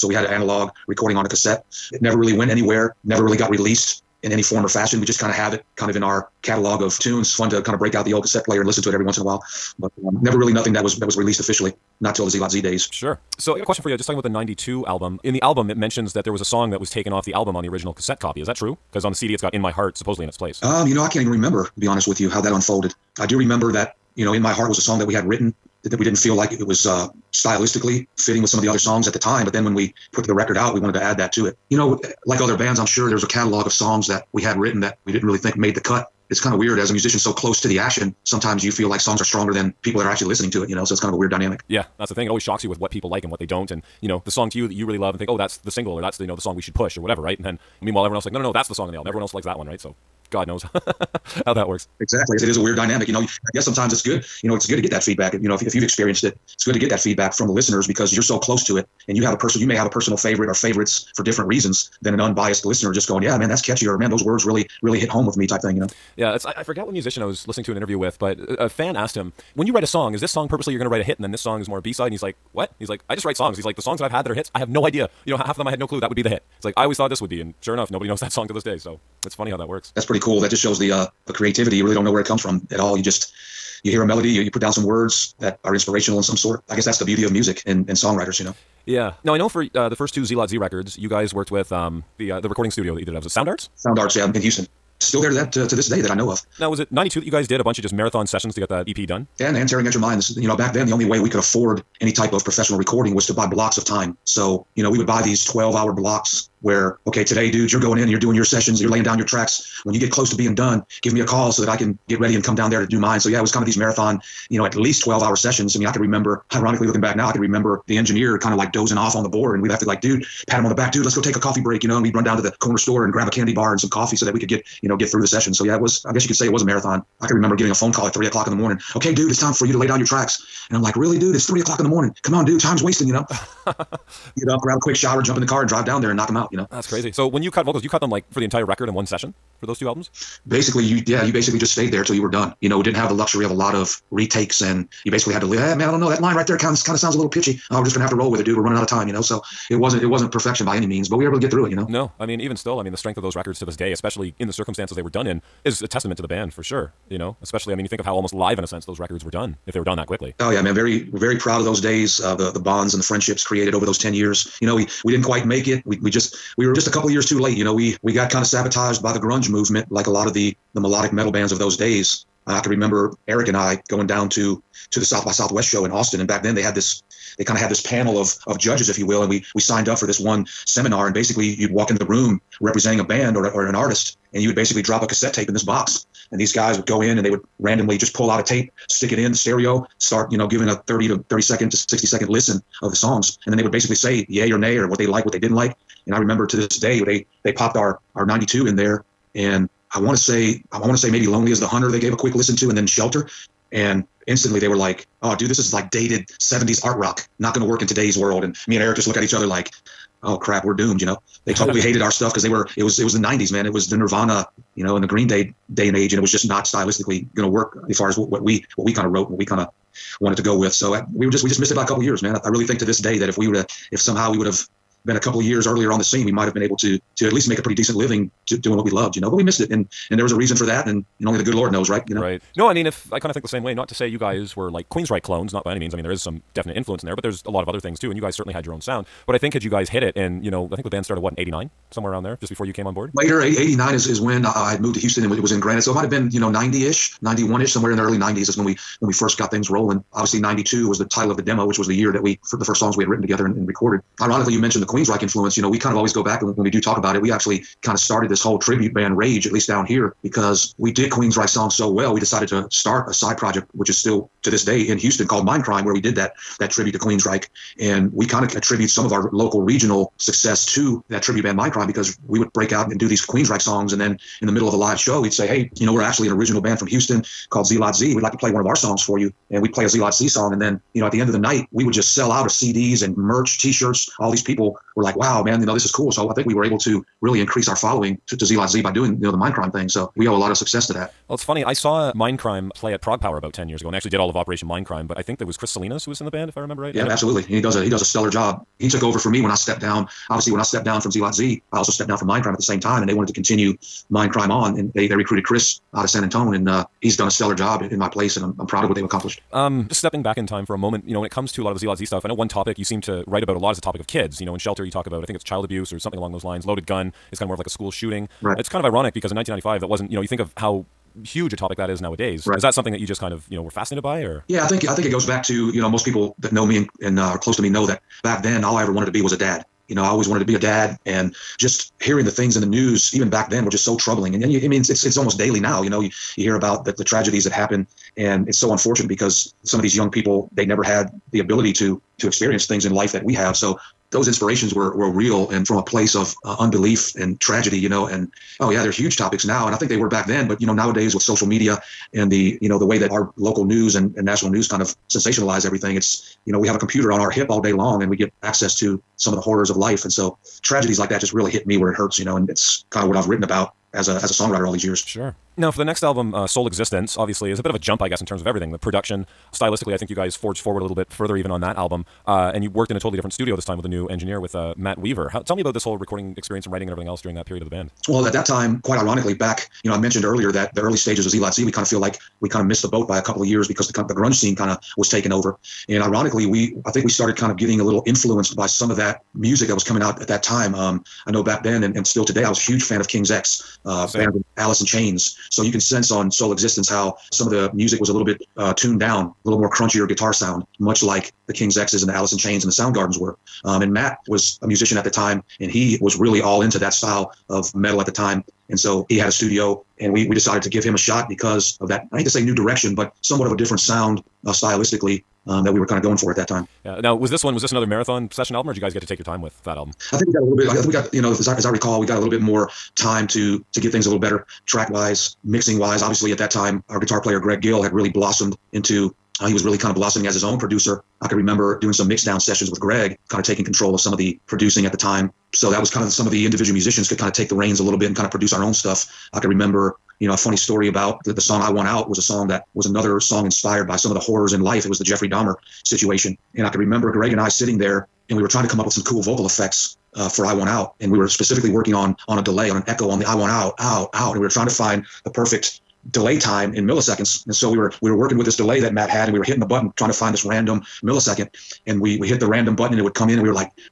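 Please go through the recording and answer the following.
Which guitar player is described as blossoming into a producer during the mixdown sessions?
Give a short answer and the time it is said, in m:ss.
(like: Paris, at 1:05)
Greg Gill, at 7:07.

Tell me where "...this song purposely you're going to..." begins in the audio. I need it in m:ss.
1:10.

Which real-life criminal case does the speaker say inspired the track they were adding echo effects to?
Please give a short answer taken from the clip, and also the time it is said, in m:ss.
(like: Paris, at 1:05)
Jeffrey Dahmer, at 7:25.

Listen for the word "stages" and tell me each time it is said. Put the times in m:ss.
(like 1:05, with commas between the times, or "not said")
6:20.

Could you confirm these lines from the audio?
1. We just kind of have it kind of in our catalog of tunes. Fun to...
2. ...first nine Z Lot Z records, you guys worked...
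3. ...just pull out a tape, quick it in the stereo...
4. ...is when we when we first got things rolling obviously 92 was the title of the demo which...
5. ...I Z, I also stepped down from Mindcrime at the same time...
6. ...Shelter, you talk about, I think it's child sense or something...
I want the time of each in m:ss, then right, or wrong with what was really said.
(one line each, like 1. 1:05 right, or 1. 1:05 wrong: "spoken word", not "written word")
1. 0:05 right
2. 1:29 wrong: "two", not "nine"
3. 3:07 wrong: "stick", not "quick"
4. 4:08 right
5. 5:01 right
6. 5:14 wrong: "abuse", not "sense".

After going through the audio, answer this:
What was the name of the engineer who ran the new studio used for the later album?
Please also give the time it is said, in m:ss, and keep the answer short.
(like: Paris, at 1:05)
Matt Weaver, at 6:14.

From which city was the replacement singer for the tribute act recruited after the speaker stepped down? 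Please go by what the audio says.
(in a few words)
San Antonio.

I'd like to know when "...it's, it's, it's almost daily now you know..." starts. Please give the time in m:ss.
5:34.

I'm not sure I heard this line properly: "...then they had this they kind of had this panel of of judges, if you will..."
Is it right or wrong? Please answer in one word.
right.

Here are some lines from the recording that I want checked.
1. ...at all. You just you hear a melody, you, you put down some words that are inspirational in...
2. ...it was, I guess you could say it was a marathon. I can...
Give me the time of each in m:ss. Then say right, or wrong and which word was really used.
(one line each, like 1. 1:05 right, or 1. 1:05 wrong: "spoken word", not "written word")
1. 1:22 right
2. 2:05 right.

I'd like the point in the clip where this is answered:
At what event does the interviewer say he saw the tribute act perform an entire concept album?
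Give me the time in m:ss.
4:53.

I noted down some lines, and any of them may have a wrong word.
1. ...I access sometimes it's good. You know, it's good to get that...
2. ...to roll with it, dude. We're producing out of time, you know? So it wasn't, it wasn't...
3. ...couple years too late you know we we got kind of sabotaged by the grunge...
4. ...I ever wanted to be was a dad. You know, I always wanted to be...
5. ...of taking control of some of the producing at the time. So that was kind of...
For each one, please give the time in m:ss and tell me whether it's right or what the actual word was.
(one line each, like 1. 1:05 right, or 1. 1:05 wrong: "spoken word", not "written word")
1. 0:53 wrong: "guess", not "access"
2. 2:28 wrong: "running", not "producing"
3. 2:46 right
4. 5:28 right
5. 7:13 right.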